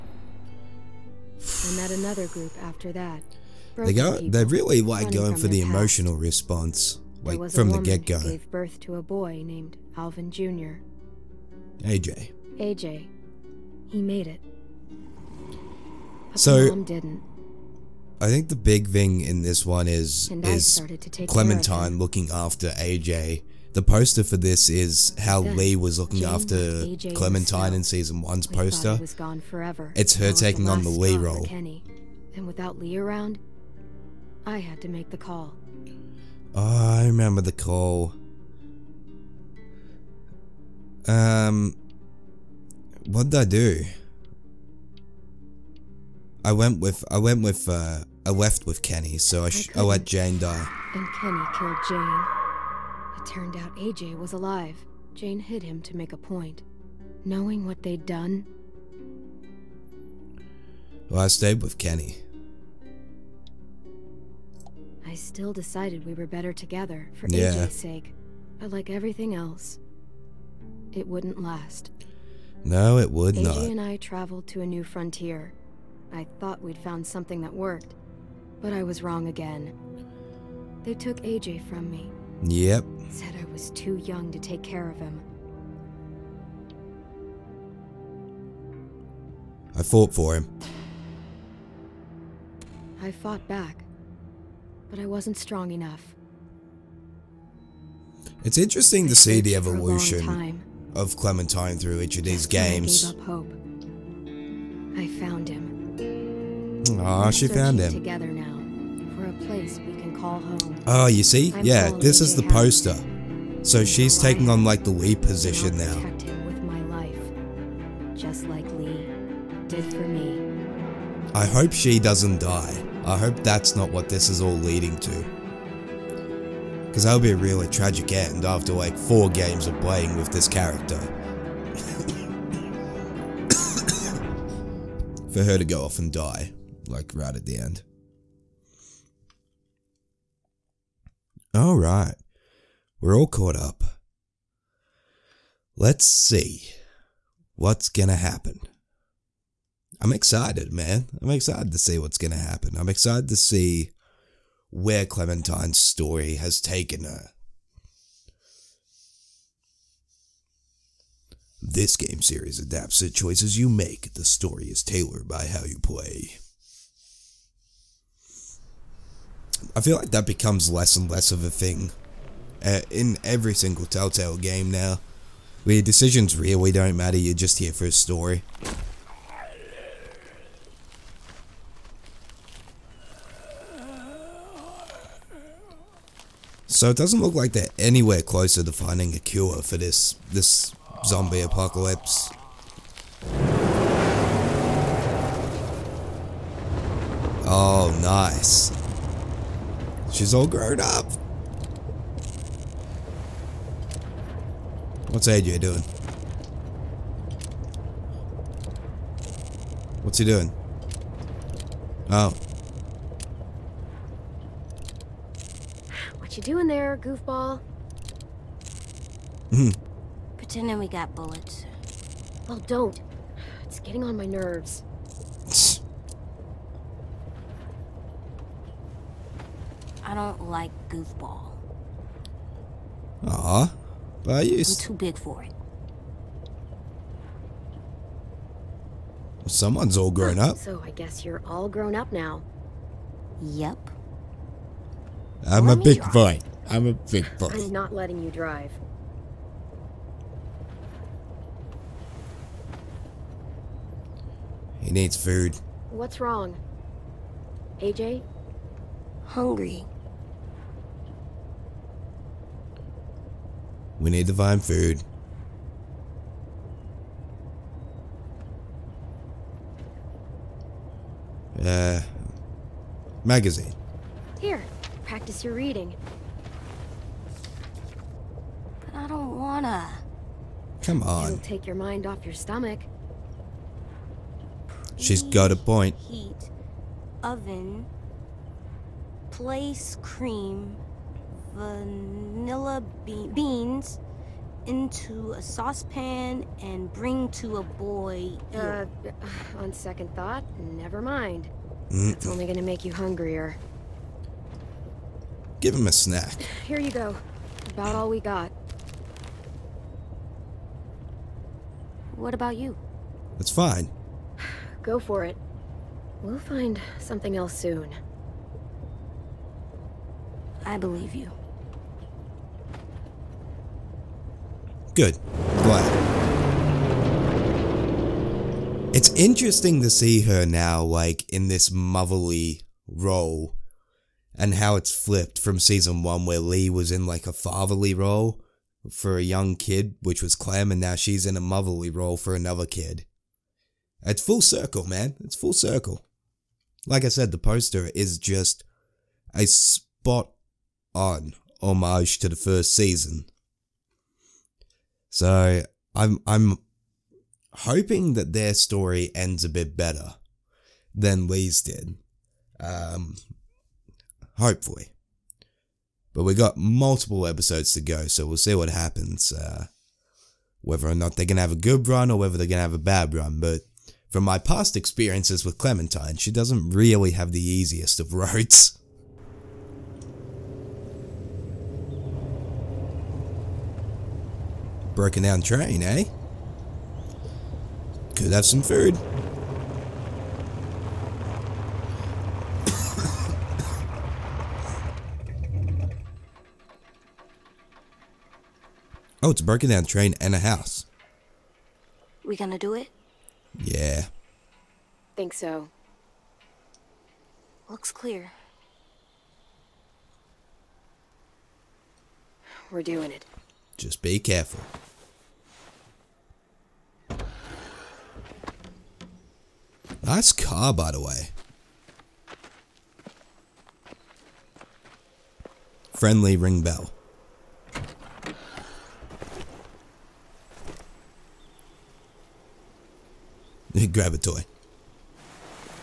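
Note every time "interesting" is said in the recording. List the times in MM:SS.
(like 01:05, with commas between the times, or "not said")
01:38, 05:29.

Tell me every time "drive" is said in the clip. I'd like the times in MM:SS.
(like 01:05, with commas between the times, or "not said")
04:08.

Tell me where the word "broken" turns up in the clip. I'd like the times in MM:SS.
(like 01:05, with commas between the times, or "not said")
06:24, 06:39.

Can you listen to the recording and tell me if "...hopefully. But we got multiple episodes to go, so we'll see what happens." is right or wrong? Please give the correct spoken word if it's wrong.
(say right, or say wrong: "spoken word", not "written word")
right.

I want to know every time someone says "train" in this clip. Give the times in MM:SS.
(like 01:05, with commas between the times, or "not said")
06:25, 06:39.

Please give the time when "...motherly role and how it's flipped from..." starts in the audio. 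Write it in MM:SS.
05:31.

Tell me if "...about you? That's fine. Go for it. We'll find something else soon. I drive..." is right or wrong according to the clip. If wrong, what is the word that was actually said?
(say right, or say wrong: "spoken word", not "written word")
wrong: "believe", not "drive".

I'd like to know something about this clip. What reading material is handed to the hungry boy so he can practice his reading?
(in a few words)
magazine.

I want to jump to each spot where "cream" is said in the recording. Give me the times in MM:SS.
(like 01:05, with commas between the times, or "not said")
04:50.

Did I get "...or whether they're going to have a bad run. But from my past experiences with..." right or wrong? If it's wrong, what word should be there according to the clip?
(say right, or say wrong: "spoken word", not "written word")
right.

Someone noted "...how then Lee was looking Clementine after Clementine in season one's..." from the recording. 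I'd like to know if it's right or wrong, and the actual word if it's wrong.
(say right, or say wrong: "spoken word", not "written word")
wrong: "Jane", not "Clementine".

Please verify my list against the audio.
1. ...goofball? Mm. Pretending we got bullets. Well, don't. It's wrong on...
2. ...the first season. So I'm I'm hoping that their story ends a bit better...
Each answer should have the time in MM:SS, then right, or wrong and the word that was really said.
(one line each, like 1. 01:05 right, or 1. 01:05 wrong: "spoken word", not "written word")
1. 03:36 wrong: "getting", not "wrong"
2. 05:52 right.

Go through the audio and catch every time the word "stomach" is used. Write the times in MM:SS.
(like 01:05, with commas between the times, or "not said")
04:42.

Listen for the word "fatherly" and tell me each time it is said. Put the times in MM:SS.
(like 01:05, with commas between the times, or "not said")
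05:37.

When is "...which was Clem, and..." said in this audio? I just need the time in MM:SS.
05:40.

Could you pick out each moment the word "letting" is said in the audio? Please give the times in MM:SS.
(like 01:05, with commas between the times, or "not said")
04:07.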